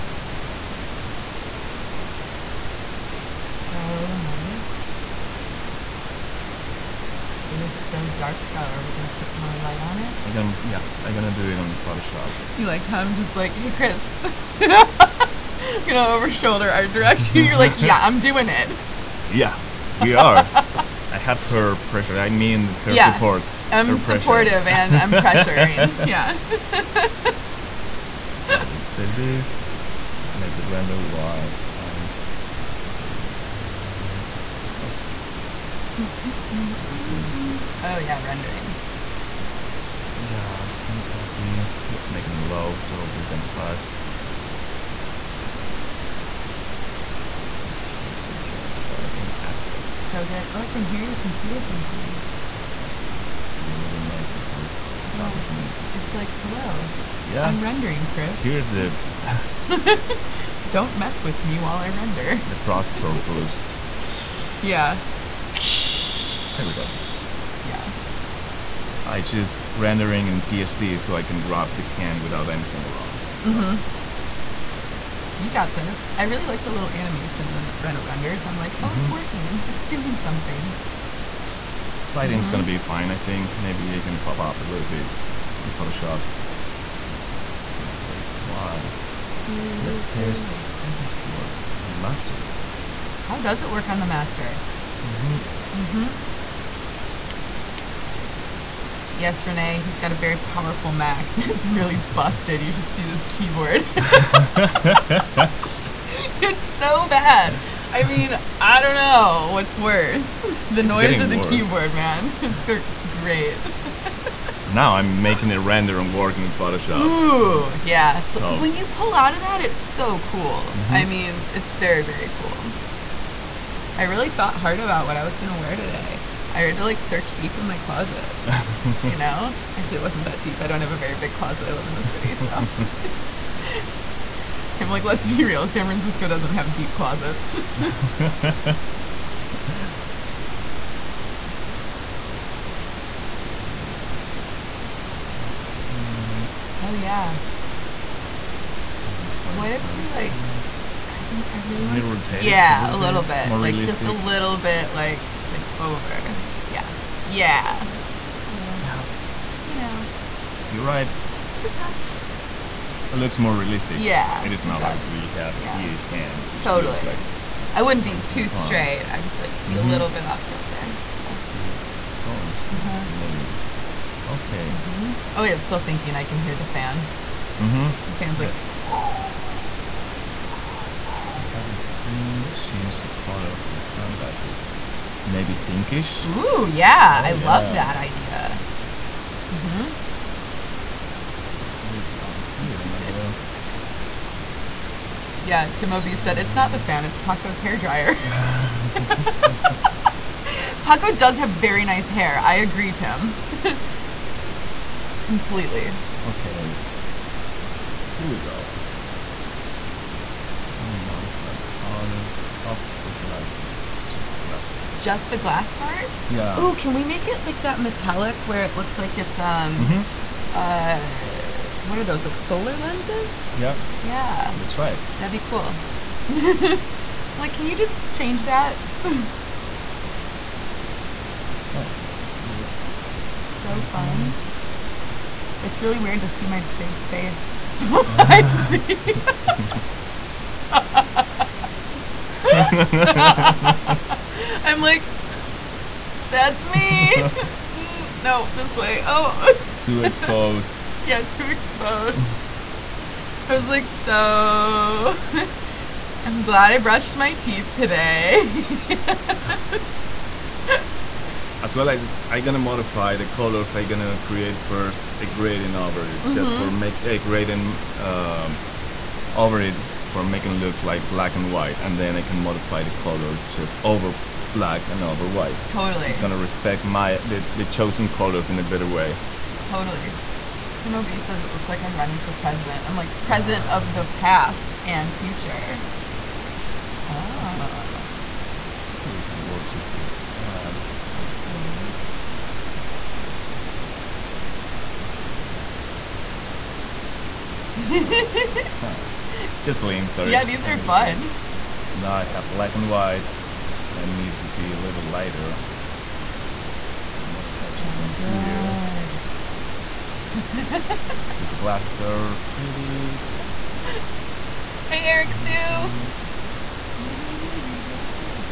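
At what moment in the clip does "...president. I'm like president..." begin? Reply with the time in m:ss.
4:42.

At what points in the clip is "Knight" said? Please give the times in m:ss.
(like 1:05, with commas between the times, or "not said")
not said.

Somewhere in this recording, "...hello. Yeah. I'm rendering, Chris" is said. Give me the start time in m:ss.
0:56.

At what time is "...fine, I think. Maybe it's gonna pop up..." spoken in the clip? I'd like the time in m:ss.
1:23.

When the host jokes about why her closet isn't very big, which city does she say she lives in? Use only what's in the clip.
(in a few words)
San Francisco.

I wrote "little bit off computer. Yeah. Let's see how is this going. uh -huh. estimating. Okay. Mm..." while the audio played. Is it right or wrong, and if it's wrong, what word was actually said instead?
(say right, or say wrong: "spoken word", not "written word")
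wrong: "kilter", not "computer".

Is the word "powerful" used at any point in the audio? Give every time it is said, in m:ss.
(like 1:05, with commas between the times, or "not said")
1:40.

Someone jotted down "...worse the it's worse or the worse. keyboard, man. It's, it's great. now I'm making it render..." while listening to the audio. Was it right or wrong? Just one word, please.
wrong.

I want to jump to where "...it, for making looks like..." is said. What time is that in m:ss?
4:29.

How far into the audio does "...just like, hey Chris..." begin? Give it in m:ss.
0:13.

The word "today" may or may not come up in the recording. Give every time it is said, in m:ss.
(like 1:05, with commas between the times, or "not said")
2:05, 4:17.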